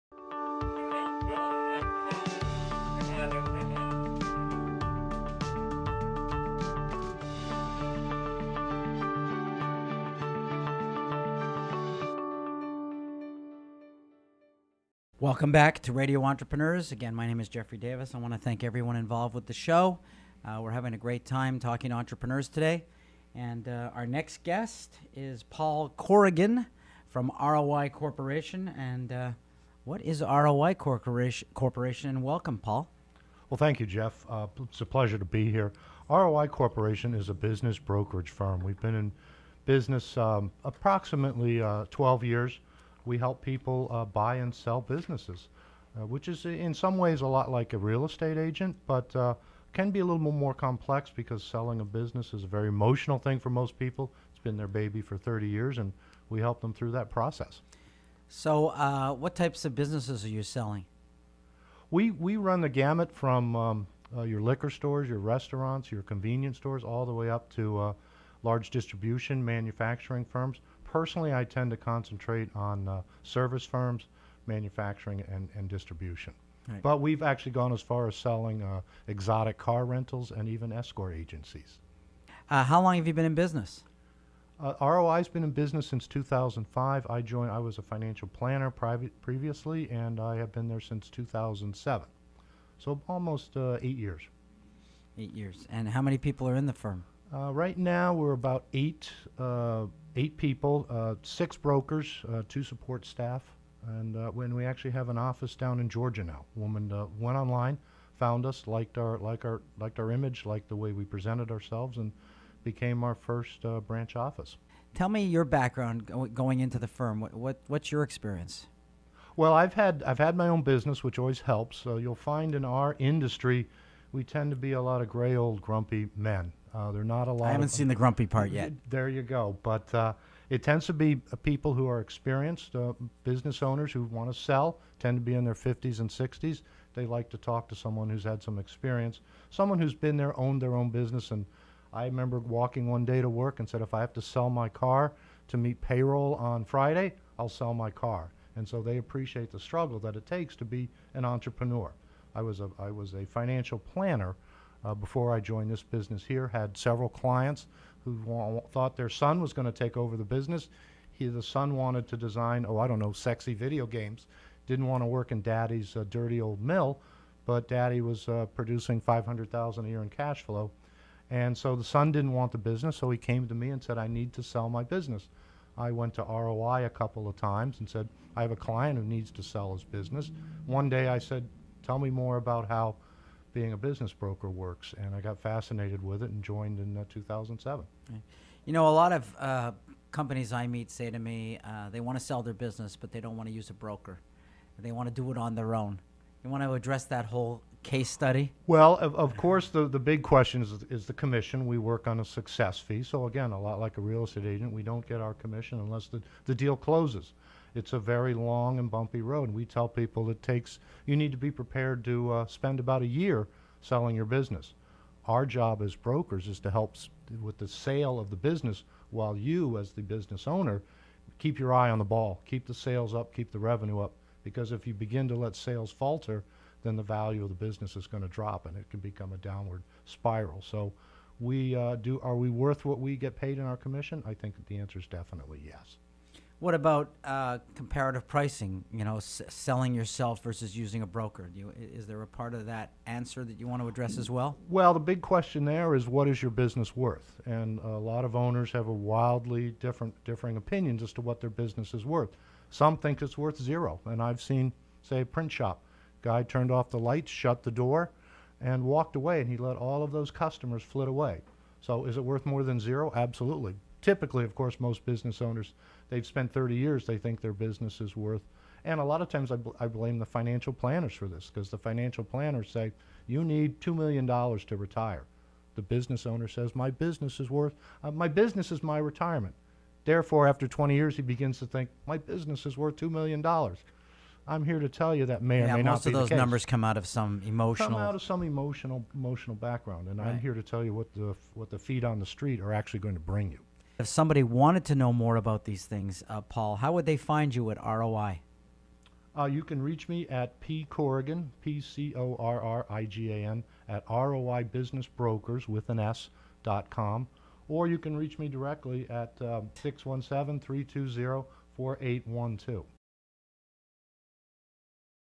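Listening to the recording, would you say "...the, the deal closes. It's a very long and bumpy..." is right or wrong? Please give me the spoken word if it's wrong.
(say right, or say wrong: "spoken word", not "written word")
right.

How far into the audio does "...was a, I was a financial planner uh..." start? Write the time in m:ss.
2:32.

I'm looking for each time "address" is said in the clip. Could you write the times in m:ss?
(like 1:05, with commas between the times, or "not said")
3:16, 4:03.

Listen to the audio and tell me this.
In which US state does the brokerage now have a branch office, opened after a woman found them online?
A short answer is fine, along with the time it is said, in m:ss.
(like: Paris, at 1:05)
Georgia, at 1:45.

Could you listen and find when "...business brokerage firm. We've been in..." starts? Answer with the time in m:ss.
0:37.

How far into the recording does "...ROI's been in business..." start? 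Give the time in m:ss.
1:24.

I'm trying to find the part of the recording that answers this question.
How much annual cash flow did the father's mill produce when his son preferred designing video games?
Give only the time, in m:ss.
2:49.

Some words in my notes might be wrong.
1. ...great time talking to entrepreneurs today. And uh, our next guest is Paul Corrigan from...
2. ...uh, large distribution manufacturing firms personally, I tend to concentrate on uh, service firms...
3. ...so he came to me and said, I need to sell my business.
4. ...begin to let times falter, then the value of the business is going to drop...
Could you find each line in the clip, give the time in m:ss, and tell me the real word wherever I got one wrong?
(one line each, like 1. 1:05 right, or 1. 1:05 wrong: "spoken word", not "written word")
1. 0:20 right
2. 1:07 right
3. 2:52 right
4. 3:44 wrong: "sales", not "times".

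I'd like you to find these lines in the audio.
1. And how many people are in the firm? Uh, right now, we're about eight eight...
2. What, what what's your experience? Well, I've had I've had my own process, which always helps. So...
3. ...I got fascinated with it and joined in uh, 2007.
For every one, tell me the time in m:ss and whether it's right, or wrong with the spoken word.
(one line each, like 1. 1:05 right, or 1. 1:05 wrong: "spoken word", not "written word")
1. 1:35 right
2. 1:57 wrong: "business", not "process"
3. 3:05 right.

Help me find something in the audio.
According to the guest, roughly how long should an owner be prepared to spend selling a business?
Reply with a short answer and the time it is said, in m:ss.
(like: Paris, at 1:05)
About a year, at 3:32.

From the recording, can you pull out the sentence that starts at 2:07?
I haven't of, seen the grumpy part yet.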